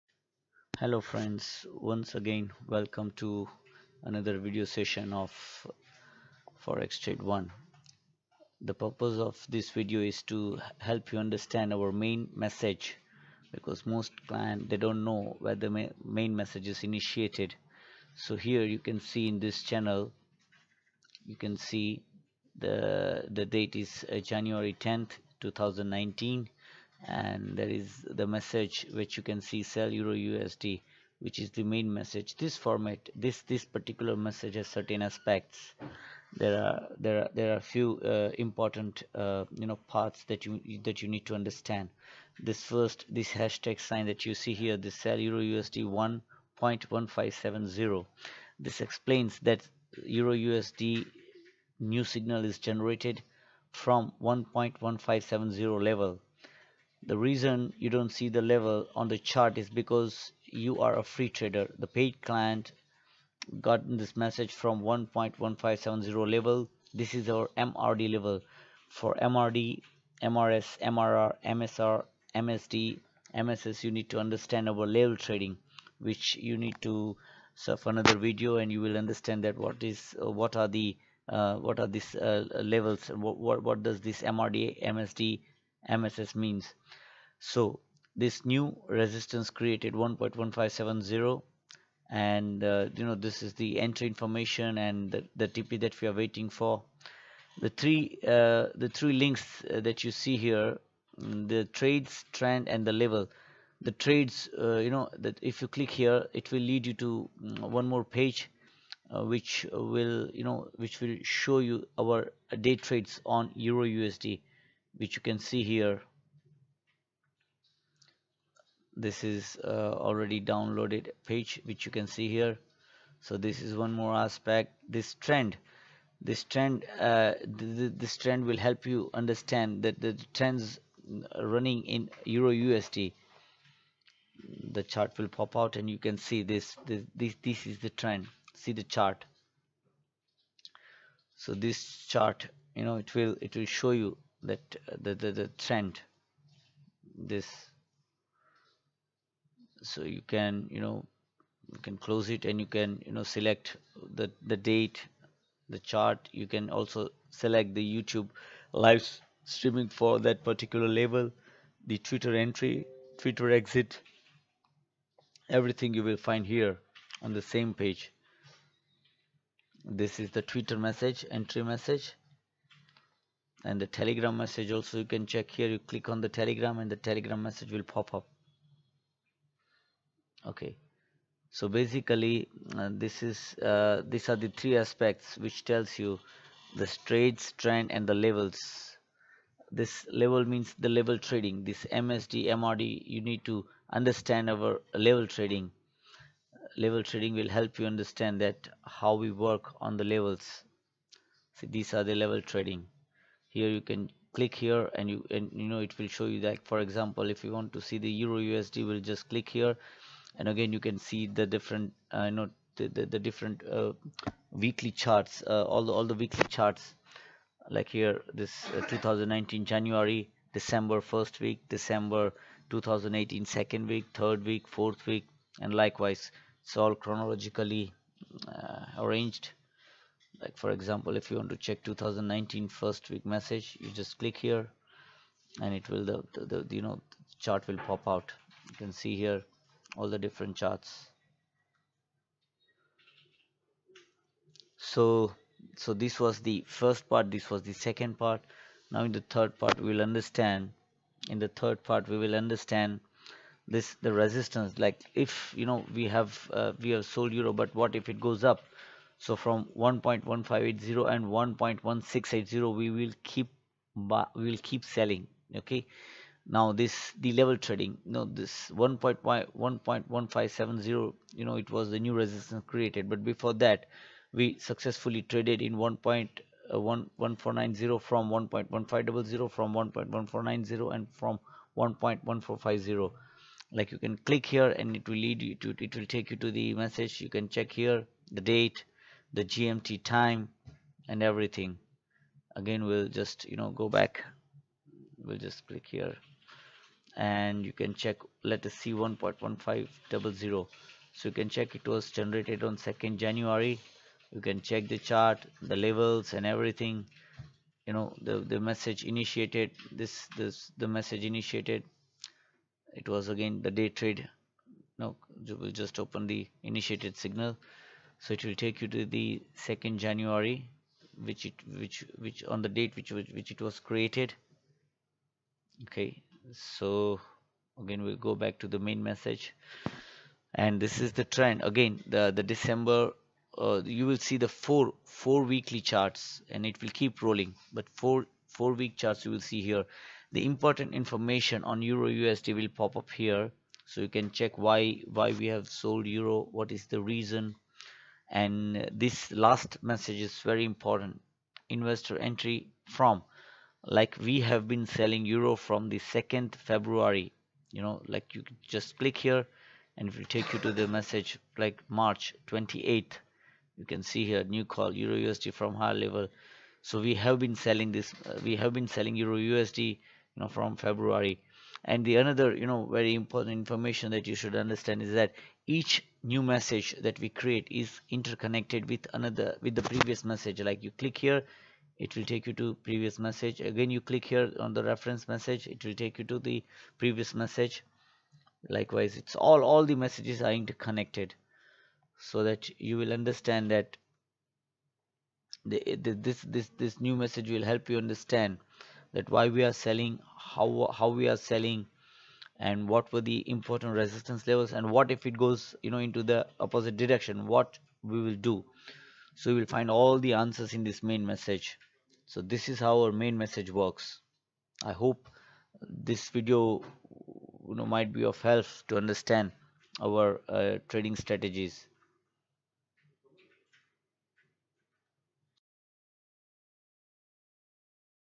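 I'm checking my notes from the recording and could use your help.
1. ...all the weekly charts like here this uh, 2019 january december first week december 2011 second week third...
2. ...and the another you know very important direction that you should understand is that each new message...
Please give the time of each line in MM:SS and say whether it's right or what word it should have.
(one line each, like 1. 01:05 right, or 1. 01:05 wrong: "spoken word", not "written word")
1. 03:35 wrong: "2018", not "2011"
2. 06:11 wrong: "information", not "direction".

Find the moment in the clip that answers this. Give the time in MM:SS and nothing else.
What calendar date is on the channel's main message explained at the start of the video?
00:24.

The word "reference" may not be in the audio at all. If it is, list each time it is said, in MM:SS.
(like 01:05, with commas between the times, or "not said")
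06:24.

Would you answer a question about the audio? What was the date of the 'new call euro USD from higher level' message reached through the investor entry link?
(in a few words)
March 28th.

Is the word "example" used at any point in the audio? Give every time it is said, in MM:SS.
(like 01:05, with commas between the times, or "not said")
03:26, 03:50.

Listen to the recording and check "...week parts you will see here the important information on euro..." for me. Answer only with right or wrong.
wrong.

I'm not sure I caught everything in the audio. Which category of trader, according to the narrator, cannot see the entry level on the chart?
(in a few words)
free trader.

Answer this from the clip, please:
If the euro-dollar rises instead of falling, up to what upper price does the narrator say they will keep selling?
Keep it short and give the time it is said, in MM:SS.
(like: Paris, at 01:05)
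1.1680, at 04:21.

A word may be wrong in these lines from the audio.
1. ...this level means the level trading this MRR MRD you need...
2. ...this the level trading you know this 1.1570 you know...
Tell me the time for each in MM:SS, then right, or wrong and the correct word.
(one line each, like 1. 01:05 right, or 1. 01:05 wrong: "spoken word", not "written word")
1. 03:09 wrong: "MSD", not "MRR"
2. 04:26 right.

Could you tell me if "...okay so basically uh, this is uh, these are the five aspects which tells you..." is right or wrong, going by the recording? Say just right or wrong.
wrong.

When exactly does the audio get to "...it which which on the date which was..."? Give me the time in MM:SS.
05:21.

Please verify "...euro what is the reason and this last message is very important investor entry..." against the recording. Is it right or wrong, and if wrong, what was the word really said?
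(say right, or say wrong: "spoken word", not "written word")
right.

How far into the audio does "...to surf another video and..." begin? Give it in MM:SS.
01:16.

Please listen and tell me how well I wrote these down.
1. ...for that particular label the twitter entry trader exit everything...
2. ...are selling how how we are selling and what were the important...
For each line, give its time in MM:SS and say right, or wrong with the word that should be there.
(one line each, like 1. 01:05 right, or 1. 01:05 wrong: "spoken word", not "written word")
1. 02:39 wrong: "twitter", not "trader"
2. 06:39 right.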